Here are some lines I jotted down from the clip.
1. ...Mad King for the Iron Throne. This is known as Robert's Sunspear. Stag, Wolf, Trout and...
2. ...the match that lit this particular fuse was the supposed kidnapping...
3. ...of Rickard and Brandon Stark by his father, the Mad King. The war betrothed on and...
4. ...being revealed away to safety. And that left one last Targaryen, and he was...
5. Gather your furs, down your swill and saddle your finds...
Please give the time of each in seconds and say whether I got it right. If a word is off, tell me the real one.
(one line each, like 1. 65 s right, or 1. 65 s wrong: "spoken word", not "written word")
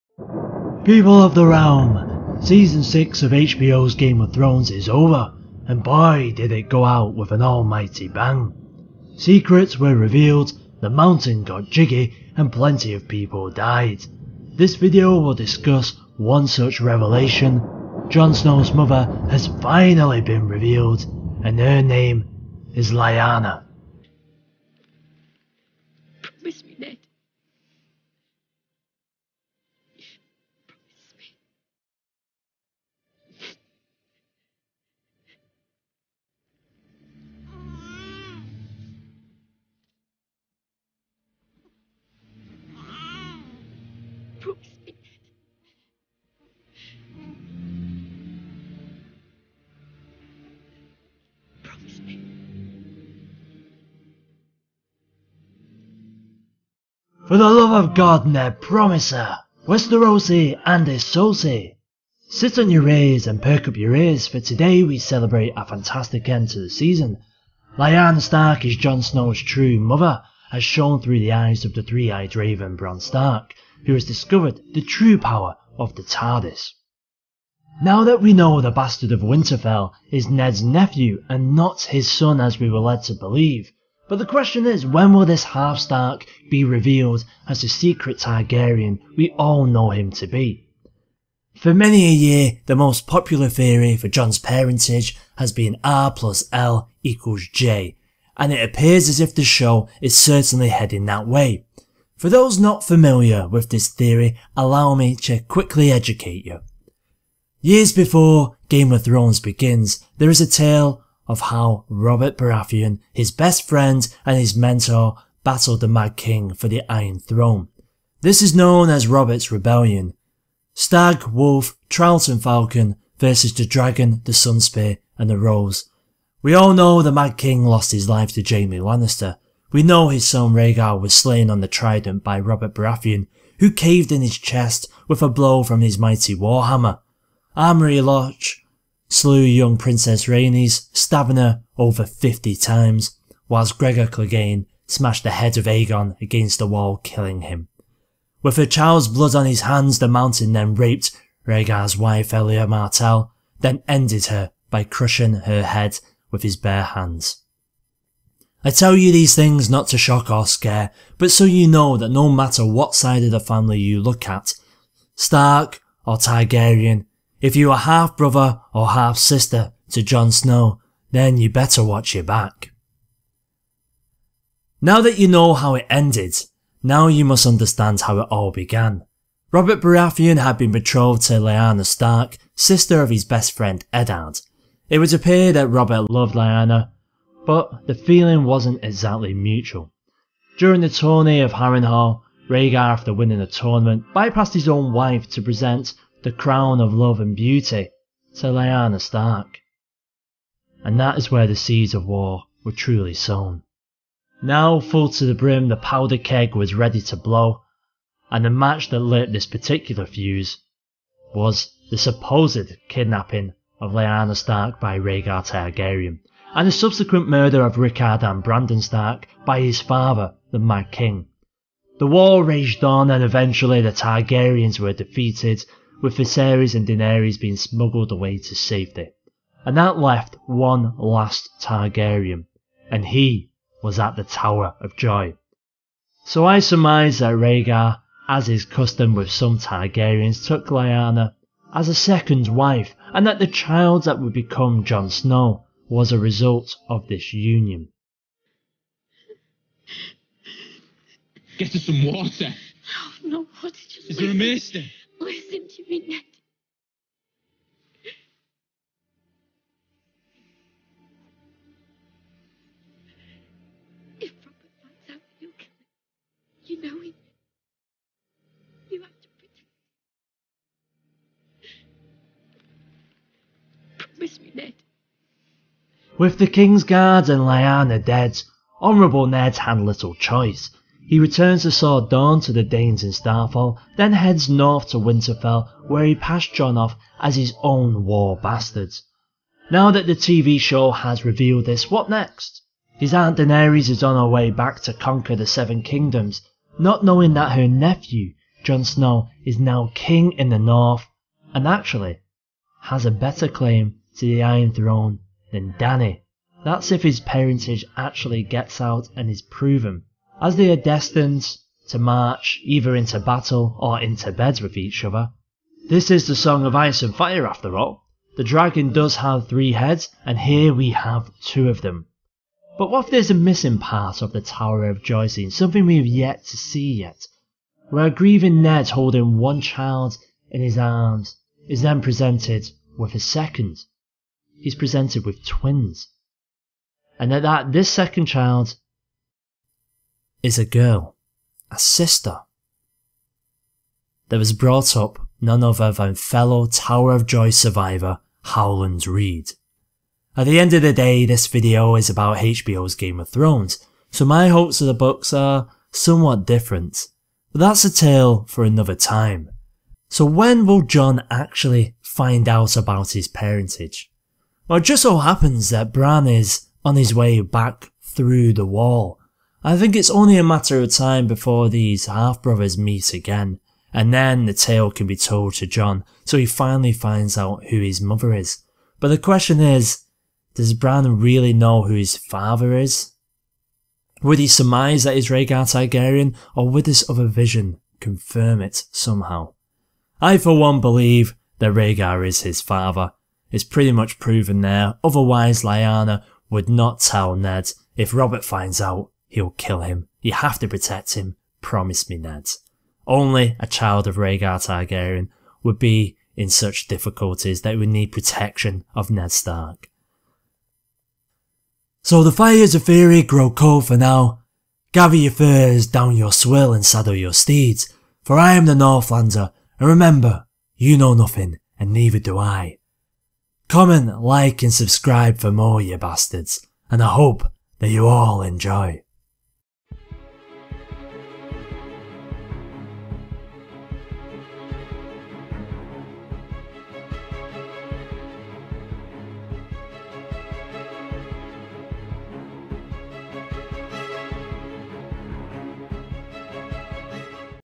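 1. 115 s wrong: "Rebellion", not "Sunspear"
2. 208 s right
3. 217 s wrong: "raged", not "betrothed"
4. 227 s wrong: "smuggled", not "revealed"
5. 414 s wrong: "steeds", not "finds".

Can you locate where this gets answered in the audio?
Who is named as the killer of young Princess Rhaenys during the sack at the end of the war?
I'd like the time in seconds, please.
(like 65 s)
137 s.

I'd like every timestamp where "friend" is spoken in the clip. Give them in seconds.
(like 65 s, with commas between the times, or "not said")
113 s, 183 s.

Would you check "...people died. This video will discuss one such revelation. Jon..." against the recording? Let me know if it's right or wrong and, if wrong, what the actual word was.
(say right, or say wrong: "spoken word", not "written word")
right.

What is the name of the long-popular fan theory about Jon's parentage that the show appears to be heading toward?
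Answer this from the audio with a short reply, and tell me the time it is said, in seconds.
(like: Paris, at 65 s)
R plus L equals J, at 95 s.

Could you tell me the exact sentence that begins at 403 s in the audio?
Only a child of Rhaegar Targaryen would be in such difficulties that would need protection of Ned Stark.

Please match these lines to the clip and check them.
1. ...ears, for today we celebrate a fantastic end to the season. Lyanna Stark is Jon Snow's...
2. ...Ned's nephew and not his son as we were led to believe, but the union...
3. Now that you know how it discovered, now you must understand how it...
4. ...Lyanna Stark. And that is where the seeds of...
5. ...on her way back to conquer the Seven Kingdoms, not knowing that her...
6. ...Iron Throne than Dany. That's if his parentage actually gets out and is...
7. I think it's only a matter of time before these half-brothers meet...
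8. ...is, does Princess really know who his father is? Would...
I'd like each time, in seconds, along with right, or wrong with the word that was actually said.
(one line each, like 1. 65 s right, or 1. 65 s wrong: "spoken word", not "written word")
1. 63 s right
2. 80 s wrong: "question", not "union"
3. 174 s wrong: "ended", not "discovered"
4. 198 s right
5. 294 s right
6. 304 s right
7. 369 s right
8. 379 s wrong: "Bran", not "Princess".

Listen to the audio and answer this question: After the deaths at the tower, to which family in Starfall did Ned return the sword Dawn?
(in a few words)
The Daynes.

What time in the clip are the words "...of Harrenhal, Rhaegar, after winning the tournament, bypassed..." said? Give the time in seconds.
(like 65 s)
191 s.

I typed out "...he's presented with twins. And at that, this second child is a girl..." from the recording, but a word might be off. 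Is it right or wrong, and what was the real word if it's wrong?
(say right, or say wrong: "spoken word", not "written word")
right.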